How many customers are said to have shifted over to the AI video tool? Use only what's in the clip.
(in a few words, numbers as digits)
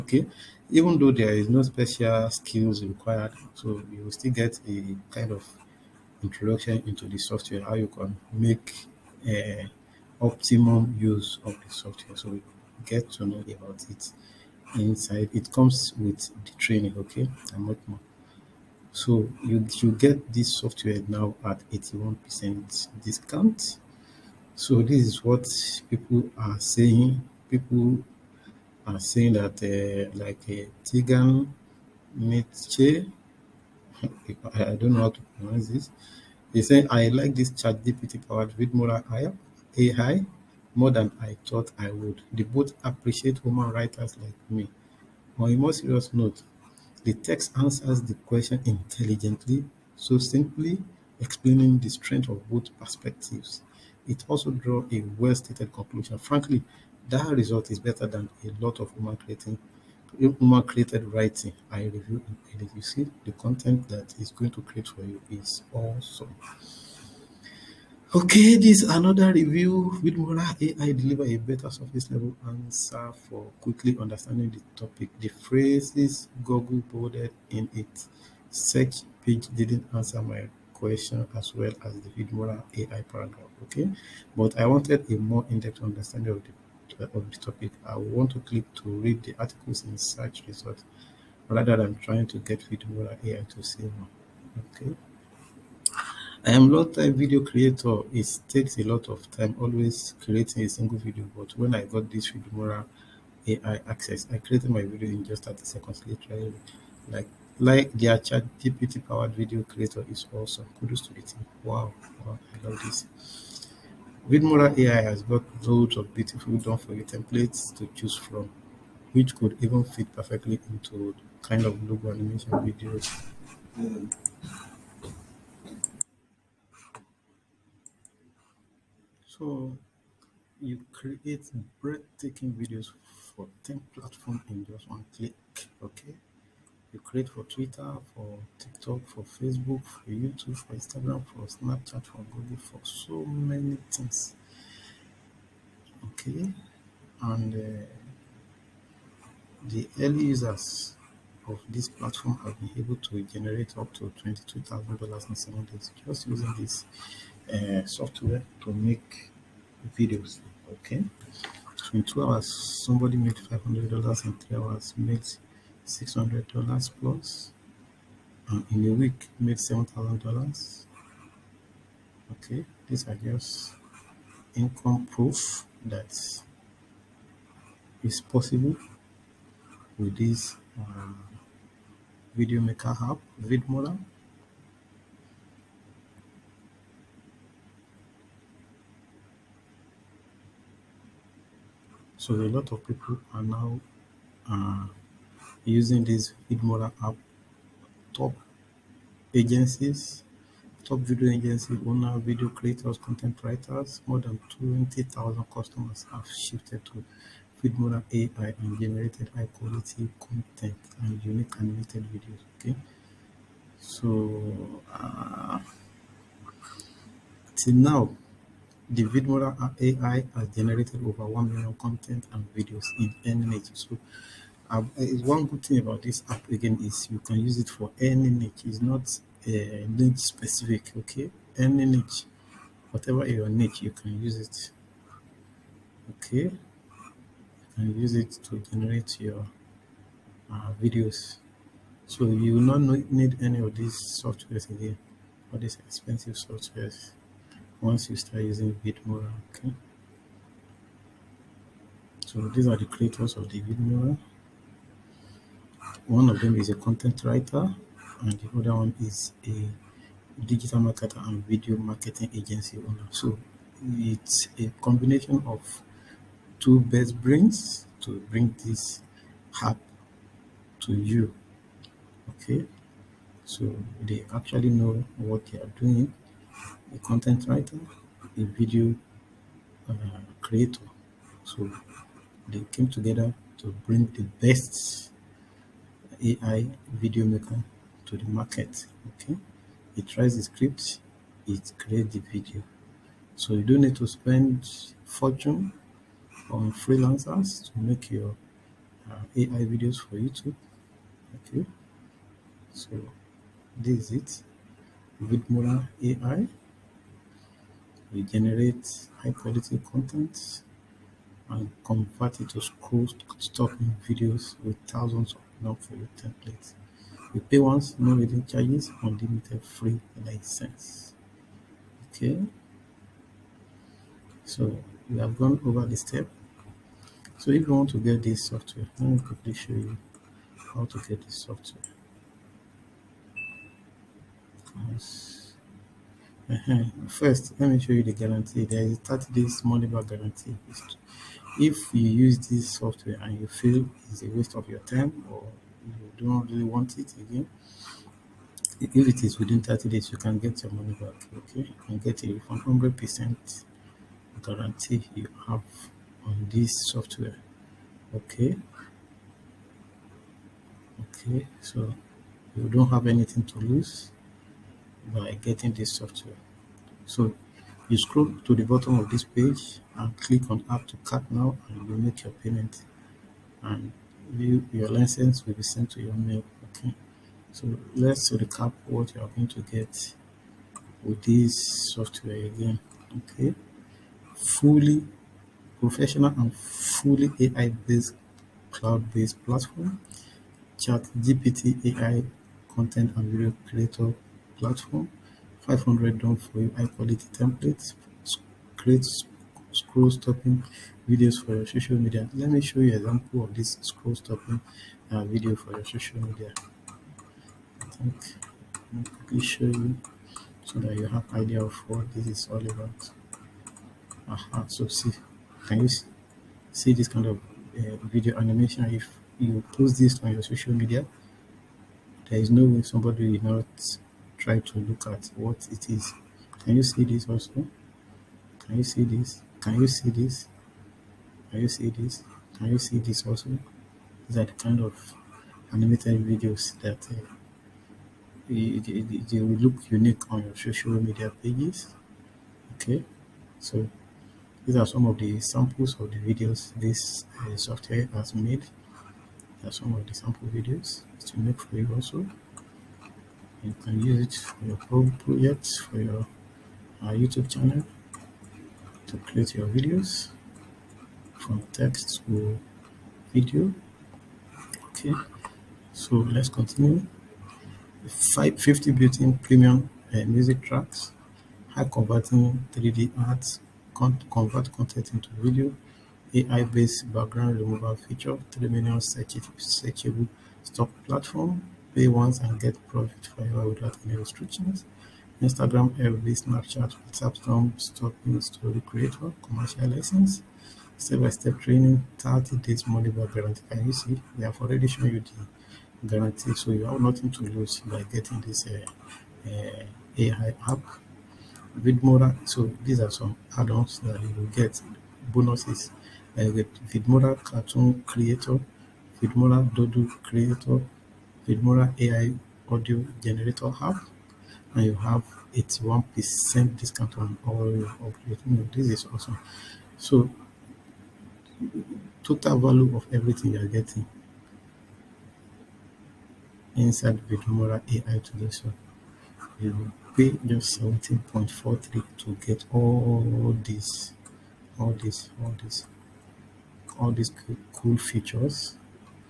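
more than 20,000.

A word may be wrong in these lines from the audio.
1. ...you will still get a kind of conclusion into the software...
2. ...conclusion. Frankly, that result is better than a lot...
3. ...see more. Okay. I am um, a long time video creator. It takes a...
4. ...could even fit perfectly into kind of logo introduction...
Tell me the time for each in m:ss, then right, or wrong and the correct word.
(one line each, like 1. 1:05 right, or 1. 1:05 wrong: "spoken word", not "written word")
1. 0:03 wrong: "introduction", not "conclusion"
2. 0:55 right
3. 1:33 right
4. 1:59 wrong: "animation", not "introduction".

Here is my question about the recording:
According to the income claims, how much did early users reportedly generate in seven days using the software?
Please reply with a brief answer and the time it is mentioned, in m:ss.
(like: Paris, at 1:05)
$22,000, at 2:34.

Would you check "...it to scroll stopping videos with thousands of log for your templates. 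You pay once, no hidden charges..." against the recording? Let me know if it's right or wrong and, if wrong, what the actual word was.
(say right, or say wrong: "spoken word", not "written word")
right.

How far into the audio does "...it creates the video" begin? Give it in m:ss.
4:51.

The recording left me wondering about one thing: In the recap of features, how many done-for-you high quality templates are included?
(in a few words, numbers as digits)
500.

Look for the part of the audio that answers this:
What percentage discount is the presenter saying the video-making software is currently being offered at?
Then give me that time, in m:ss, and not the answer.
0:21.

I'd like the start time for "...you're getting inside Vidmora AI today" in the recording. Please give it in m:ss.
8:43.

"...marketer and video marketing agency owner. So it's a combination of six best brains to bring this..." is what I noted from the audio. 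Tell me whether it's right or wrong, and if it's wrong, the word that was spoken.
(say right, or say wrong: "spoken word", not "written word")
wrong: "two", not "six".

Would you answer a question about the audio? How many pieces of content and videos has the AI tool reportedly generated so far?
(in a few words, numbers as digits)
over 1 million.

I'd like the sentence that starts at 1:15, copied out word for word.
The phrases Google boarded in its search page didn't answer my question as well as the Vidmora AI paragraph.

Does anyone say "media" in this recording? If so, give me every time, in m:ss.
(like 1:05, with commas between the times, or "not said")
6:41, 6:46, 7:00, 7:20.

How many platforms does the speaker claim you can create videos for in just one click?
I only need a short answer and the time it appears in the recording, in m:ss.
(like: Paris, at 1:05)
10, at 2:13.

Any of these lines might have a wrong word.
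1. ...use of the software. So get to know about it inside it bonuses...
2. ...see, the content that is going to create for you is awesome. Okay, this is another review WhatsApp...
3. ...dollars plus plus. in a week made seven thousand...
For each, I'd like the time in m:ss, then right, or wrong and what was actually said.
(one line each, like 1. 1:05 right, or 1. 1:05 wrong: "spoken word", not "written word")
1. 0:10 wrong: "comes", not "bonuses"
2. 1:02 wrong: "Vidmora", not "WhatsApp"
3. 2:46 right.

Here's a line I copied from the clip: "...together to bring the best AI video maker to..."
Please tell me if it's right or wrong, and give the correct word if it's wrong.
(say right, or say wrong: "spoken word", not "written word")
right.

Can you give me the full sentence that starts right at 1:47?
Like like their chat GPT powered video creator is awesome.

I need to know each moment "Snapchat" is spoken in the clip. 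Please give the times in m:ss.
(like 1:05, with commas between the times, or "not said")
2:21, 8:06.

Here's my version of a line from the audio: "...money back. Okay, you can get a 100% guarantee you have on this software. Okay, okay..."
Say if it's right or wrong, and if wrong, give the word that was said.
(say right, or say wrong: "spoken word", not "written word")
right.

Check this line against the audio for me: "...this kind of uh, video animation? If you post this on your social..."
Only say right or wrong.
right.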